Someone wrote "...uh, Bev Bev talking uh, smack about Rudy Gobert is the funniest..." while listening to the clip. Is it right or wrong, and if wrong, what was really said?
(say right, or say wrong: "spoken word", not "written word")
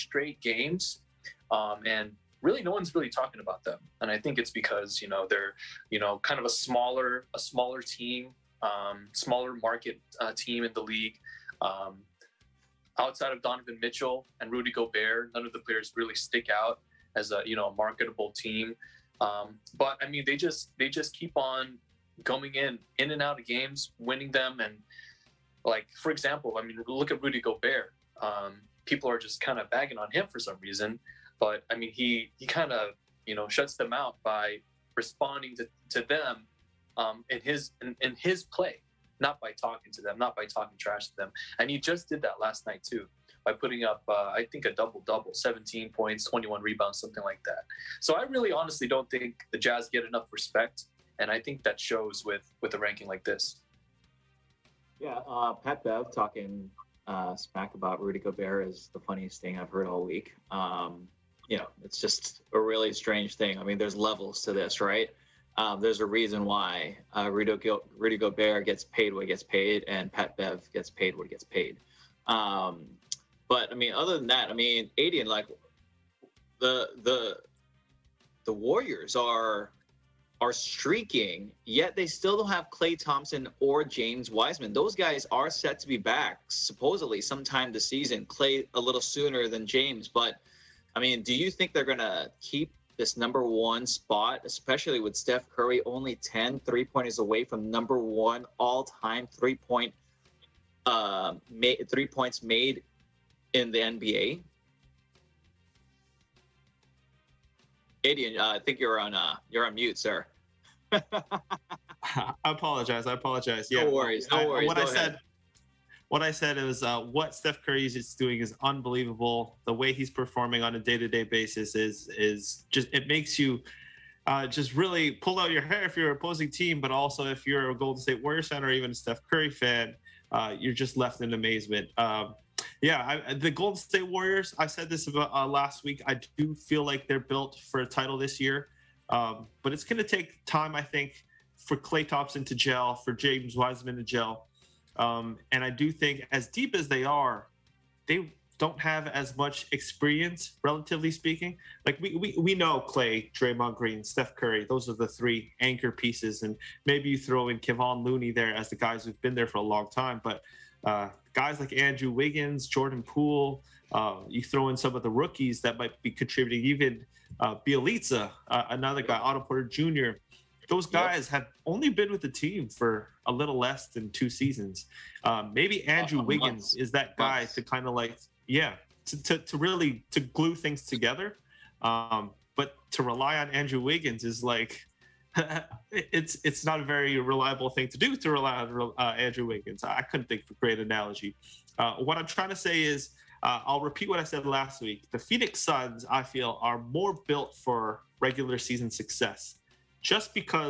wrong: "Pat", not "Bev".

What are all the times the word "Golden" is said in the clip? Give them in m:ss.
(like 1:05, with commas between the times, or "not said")
2:07, 2:13.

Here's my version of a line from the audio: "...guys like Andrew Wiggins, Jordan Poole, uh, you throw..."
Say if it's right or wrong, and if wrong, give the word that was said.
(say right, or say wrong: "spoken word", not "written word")
right.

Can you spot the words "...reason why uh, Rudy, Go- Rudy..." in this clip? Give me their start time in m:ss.
1:06.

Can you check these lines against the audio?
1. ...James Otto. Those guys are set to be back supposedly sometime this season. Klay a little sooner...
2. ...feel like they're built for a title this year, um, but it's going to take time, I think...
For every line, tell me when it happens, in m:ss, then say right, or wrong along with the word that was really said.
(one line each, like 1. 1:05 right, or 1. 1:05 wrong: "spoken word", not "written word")
1. 1:23 wrong: "Wiseman", not "Otto"
2. 2:16 right.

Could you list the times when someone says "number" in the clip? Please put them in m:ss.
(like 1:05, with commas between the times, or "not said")
1:33, 1:37.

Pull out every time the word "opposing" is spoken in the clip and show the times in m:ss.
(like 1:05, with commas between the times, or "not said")
2:06.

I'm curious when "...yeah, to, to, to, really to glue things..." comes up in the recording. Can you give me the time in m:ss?
2:58.